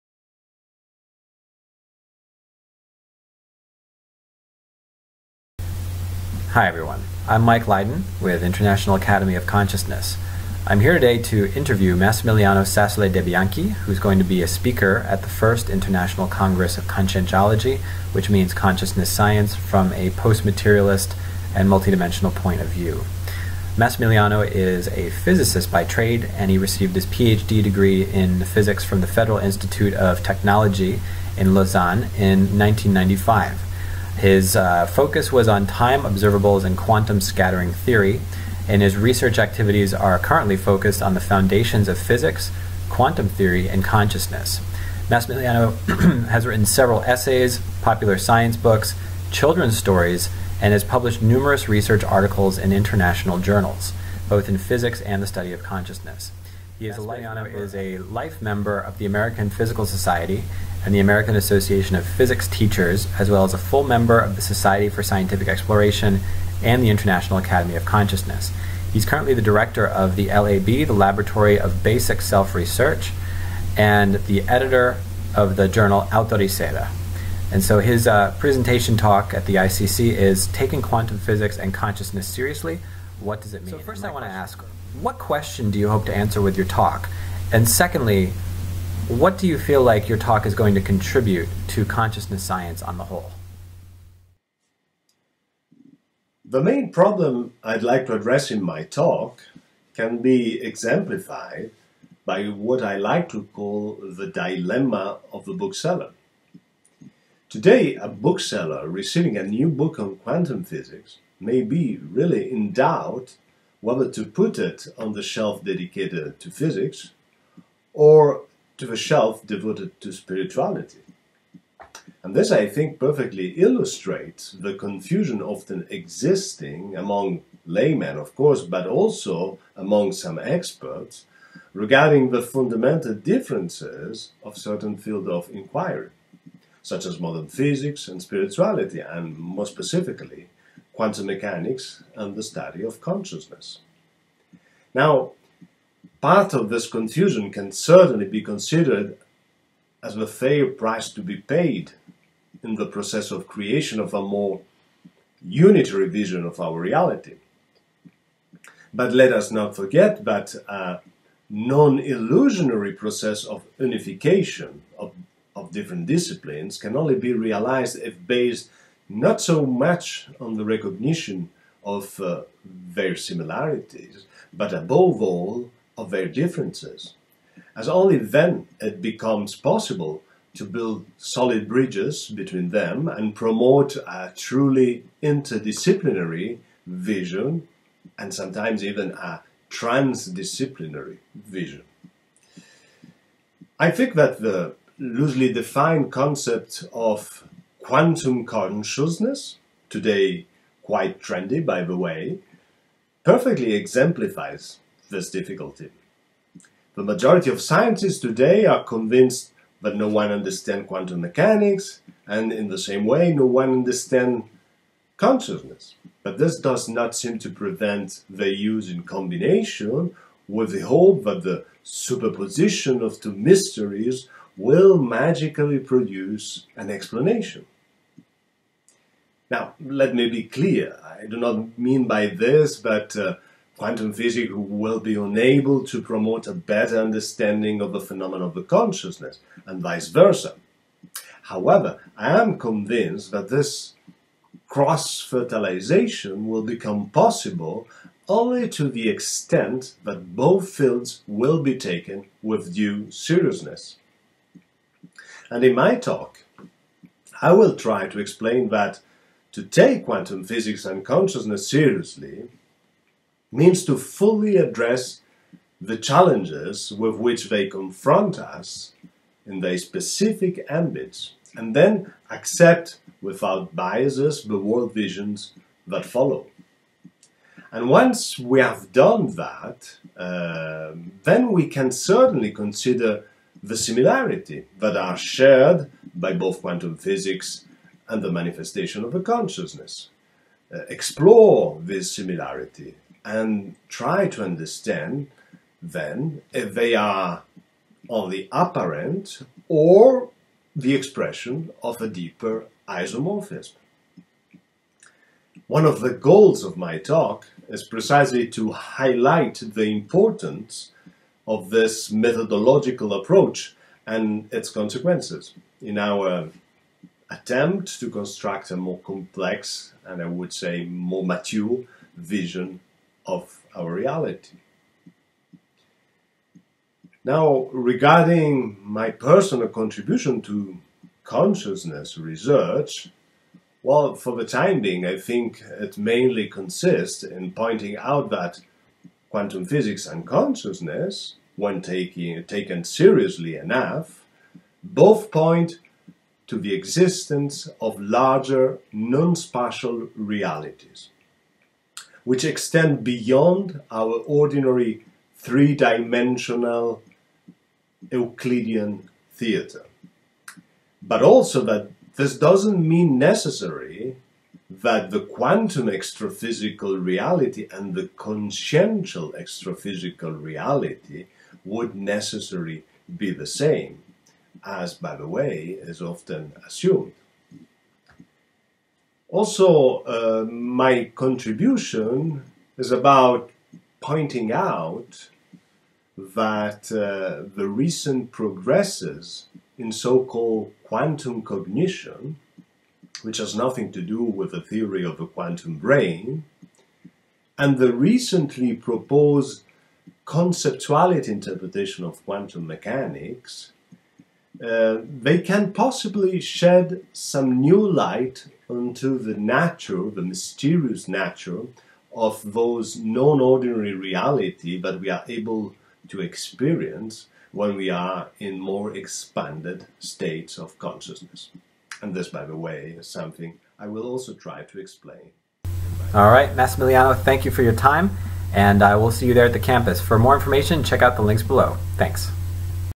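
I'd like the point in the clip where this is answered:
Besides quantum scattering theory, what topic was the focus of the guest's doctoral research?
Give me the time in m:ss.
0:35.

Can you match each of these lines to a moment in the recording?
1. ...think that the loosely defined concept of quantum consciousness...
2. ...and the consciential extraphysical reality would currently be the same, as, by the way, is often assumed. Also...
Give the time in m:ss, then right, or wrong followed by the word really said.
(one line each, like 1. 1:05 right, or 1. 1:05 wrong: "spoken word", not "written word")
1. 3:13 right
2. 6:07 wrong: "necessarily", not "currently".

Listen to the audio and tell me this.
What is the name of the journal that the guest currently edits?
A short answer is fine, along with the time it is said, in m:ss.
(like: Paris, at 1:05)
AutoRicerca, at 1:16.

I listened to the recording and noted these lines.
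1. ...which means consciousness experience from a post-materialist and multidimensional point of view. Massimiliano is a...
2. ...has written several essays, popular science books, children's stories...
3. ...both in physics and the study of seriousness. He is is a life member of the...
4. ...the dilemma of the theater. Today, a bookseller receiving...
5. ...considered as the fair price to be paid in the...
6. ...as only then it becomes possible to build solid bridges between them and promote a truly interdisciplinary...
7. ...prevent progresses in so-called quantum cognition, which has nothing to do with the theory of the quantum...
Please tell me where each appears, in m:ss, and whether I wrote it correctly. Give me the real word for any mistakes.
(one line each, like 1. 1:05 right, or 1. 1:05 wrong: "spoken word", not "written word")
1. 0:18 wrong: "science", not "experience"
2. 0:46 right
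3. 0:54 wrong: "consciousness", not "seriousness"
4. 1:44 wrong: "bookseller", not "theater"
5. 2:28 right
6. 2:57 right
7. 6:27 wrong: "recent", not "prevent".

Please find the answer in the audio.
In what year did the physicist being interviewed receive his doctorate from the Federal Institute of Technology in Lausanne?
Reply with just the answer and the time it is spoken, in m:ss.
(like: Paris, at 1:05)
1995, at 0:32.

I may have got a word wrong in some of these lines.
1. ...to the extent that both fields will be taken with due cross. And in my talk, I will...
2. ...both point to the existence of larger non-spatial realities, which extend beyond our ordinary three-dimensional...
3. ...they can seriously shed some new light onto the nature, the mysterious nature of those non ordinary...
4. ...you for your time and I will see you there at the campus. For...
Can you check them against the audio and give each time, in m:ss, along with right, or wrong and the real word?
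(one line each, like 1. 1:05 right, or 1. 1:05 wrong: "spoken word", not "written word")
1. 4:08 wrong: "seriousness", not "cross"
2. 5:44 right
3. 6:45 wrong: "possibly", not "seriously"
4. 7:07 right.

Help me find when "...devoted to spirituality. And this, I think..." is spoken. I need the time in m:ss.
1:59.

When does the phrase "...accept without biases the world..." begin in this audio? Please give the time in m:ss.
4:32.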